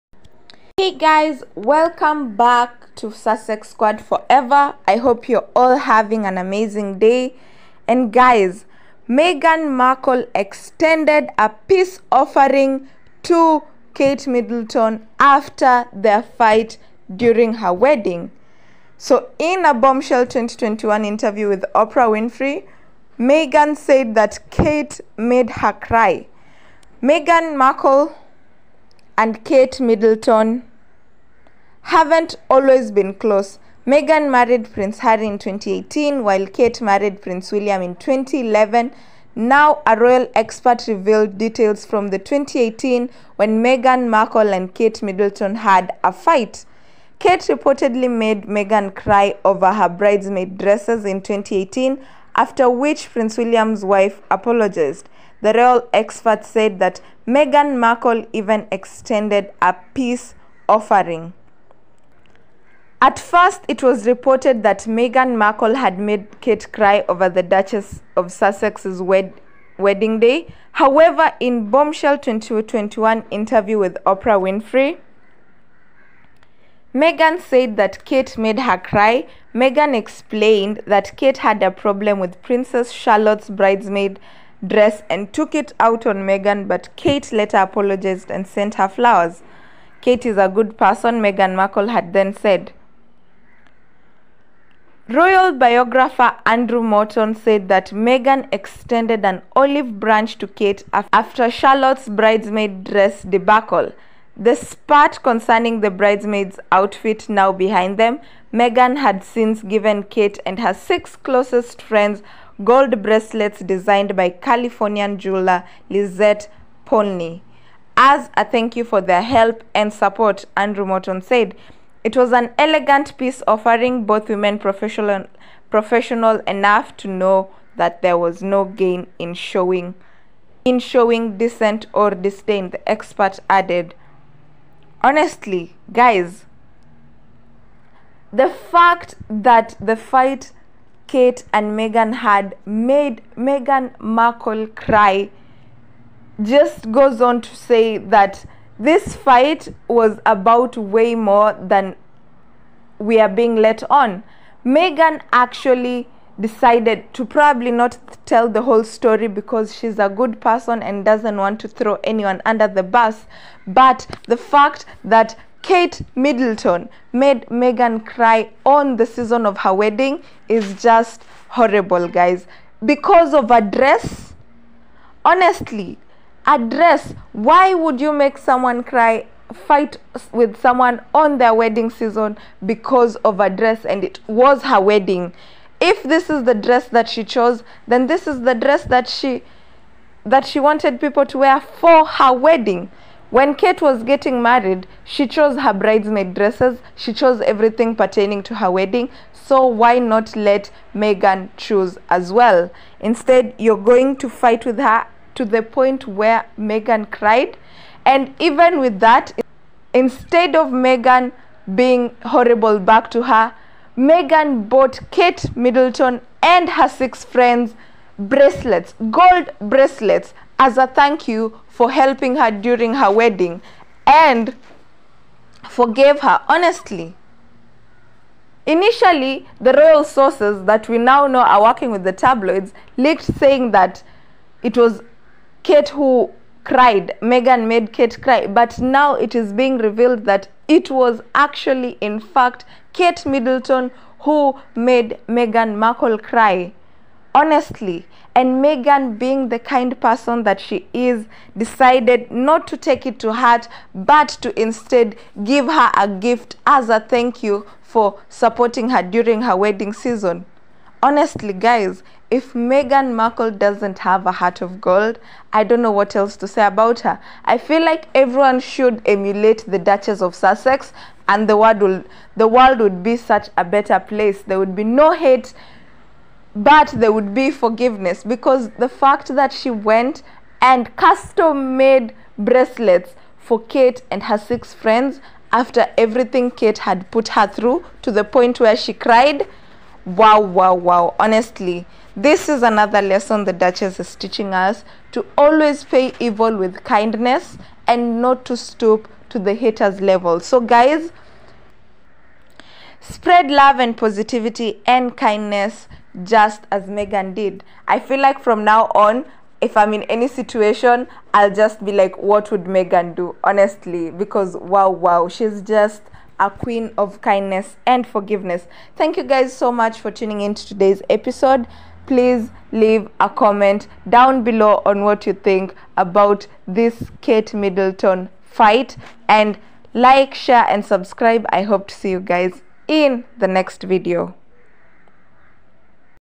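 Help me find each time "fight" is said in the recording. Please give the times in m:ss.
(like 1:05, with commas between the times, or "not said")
0:16, 0:46, 2:19, 2:29, 2:59, 3:24, 5:28.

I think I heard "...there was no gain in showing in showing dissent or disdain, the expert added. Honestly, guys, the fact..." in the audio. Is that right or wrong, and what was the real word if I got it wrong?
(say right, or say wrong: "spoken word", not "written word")
right.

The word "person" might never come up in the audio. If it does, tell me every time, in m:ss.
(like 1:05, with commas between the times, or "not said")
1:30, 2:40, 4:10.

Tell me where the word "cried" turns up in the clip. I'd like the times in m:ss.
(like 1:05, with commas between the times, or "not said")
3:27, 3:56, 4:48.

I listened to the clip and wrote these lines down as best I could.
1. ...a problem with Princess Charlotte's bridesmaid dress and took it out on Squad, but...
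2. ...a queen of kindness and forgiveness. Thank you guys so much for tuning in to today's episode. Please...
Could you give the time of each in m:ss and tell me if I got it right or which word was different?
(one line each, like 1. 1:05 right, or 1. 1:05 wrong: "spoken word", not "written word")
1. 1:21 wrong: "Meghan", not "Squad"
2. 5:16 right.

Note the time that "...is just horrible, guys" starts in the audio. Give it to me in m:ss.
2:50.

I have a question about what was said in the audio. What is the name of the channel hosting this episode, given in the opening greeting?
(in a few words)
Sussex Squad Forever.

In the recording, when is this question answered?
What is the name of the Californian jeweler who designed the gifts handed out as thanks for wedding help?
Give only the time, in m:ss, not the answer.
1:55.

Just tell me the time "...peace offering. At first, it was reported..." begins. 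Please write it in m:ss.
0:59.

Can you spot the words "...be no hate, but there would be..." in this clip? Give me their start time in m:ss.
4:34.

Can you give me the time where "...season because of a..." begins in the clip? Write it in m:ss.
3:01.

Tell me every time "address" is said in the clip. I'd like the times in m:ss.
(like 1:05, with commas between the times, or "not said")
2:56.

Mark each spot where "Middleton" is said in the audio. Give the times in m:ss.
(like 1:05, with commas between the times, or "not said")
0:14, 0:29, 0:45, 2:46, 3:35, 4:03, 5:27.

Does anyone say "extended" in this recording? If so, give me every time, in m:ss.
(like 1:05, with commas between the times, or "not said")
0:10, 0:58, 1:38.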